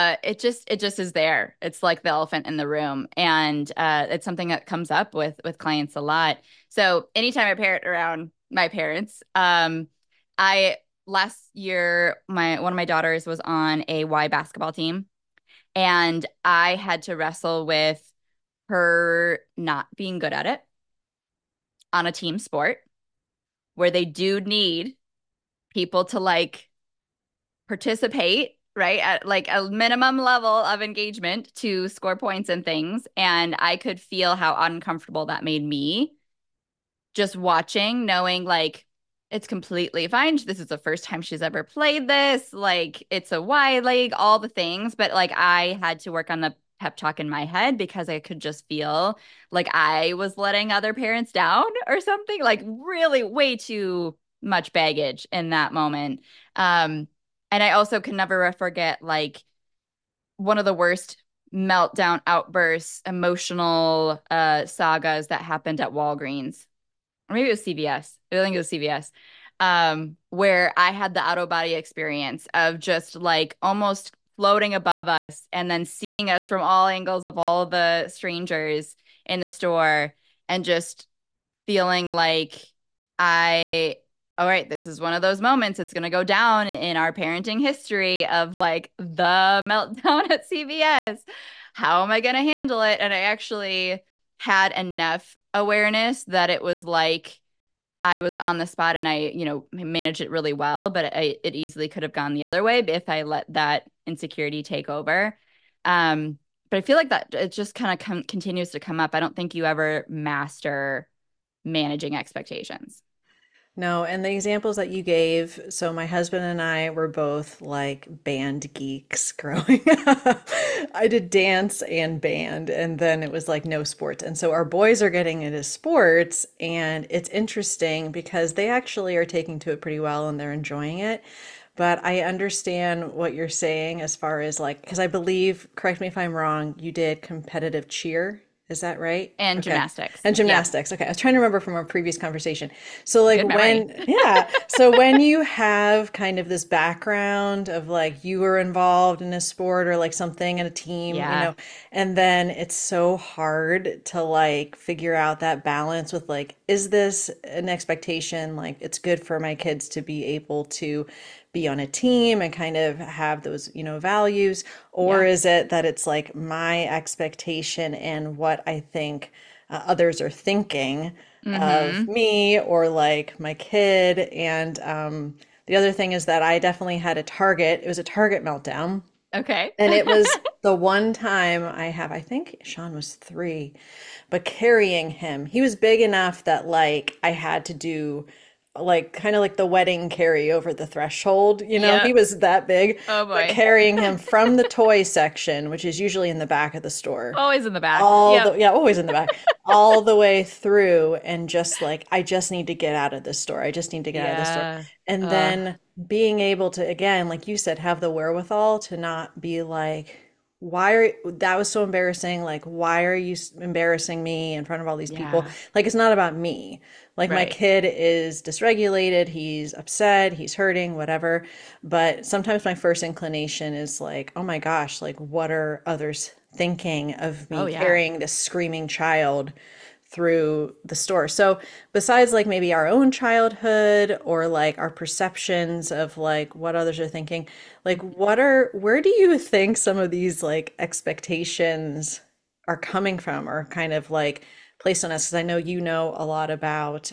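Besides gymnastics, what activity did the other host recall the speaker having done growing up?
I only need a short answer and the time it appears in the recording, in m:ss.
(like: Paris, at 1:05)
Competitive cheer, at 2:17.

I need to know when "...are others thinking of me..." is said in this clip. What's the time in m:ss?
3:45.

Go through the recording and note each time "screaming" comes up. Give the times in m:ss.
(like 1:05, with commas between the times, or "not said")
3:48.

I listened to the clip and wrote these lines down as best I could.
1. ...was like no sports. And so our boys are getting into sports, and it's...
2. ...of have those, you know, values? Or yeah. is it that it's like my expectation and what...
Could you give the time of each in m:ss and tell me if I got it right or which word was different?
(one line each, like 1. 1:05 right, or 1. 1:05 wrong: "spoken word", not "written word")
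1. 2:03 right
2. 2:42 right.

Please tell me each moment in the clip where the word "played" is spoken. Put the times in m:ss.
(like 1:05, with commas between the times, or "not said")
0:41.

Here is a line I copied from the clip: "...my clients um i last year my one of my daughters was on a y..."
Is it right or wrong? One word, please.
wrong.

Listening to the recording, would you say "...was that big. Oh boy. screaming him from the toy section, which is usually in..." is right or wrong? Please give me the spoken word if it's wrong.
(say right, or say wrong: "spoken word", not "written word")
wrong: "carrying", not "screaming".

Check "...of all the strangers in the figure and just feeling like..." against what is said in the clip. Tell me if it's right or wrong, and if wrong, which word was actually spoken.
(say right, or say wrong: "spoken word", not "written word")
wrong: "store", not "figure".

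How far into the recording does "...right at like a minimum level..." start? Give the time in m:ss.
0:28.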